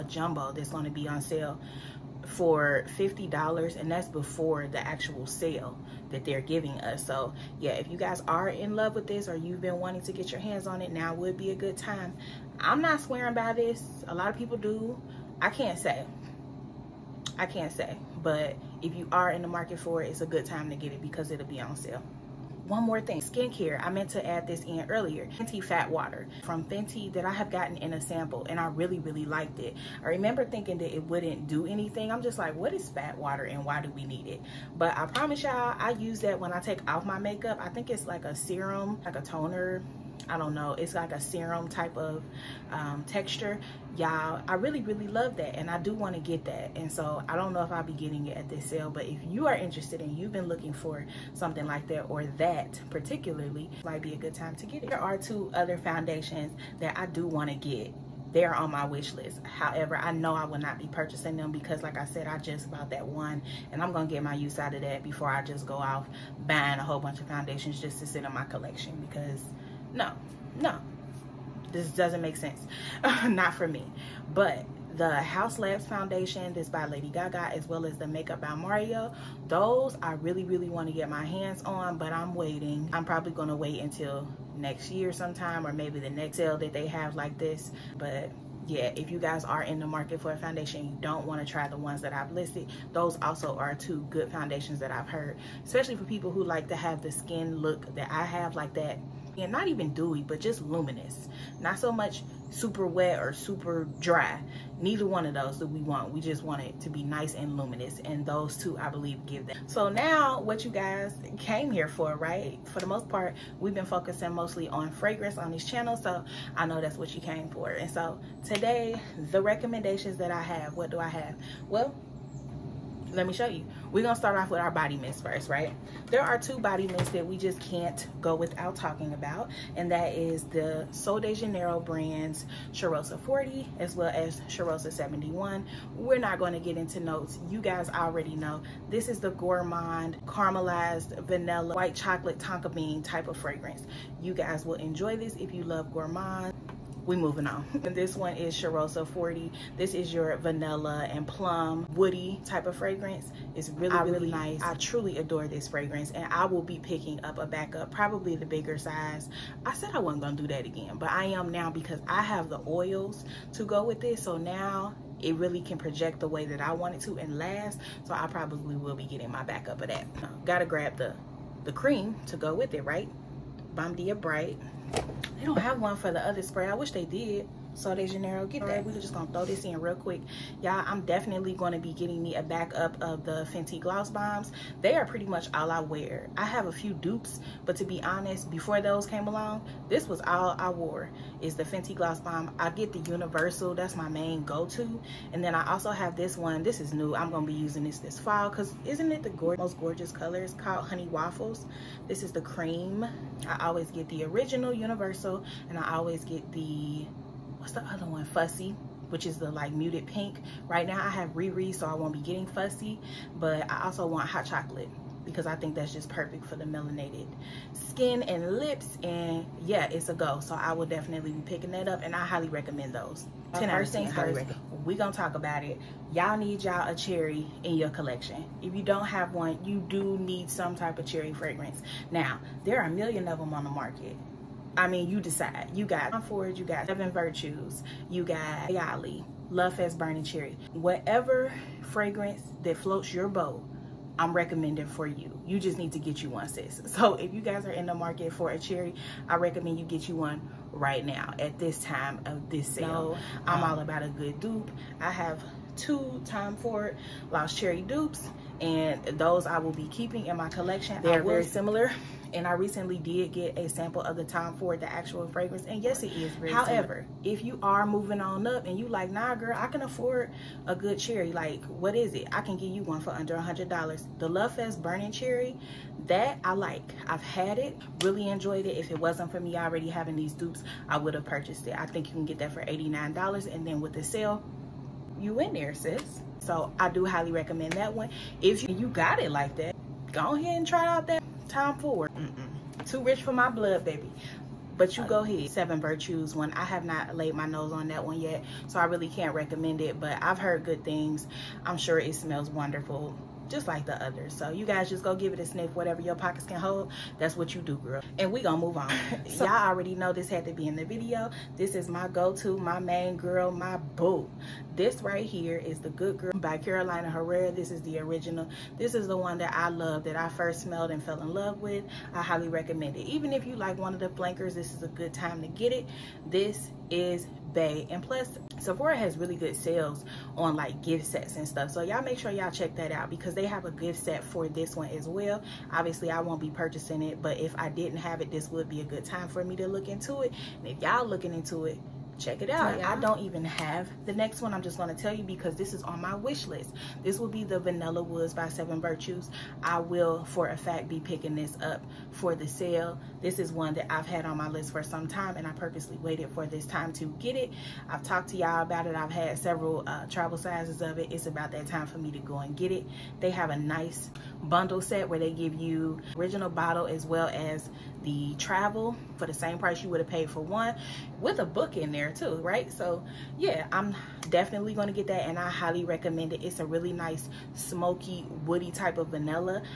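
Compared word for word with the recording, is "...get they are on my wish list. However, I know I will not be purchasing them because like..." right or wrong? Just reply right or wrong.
right.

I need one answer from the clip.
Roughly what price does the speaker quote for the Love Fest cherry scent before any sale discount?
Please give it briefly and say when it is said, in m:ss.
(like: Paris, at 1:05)
$89, at 4:42.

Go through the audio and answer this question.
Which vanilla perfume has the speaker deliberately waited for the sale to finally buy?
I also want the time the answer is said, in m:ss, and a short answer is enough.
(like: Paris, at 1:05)
Vanilla Woods, at 5:47.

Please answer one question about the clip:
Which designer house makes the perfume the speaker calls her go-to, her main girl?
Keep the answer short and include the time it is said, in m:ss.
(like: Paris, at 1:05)
Carolina Herrera, at 5:16.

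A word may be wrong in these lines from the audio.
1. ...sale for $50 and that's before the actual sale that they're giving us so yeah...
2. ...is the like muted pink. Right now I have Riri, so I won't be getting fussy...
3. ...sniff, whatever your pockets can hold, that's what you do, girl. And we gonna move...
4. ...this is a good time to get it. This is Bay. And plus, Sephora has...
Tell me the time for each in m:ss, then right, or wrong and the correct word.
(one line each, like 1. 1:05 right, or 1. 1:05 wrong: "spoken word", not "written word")
1. 0:01 right
2. 3:29 right
3. 5:05 right
4. 5:24 right.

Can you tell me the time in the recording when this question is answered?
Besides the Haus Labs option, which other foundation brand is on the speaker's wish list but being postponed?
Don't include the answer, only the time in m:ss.
1:18.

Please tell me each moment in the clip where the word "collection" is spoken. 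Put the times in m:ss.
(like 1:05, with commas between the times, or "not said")
1:08, 3:47, 4:20.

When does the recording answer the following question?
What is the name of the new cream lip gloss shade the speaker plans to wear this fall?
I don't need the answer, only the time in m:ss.
3:20.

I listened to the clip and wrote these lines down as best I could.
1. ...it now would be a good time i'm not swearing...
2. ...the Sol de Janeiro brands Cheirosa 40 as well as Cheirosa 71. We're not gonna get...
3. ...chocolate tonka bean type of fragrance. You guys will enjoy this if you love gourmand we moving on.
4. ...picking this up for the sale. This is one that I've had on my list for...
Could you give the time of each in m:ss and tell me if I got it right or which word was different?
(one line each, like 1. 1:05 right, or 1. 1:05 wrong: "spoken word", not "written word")
1. 0:10 right
2. 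2:10 right
3. 2:21 right
4. 5:51 right.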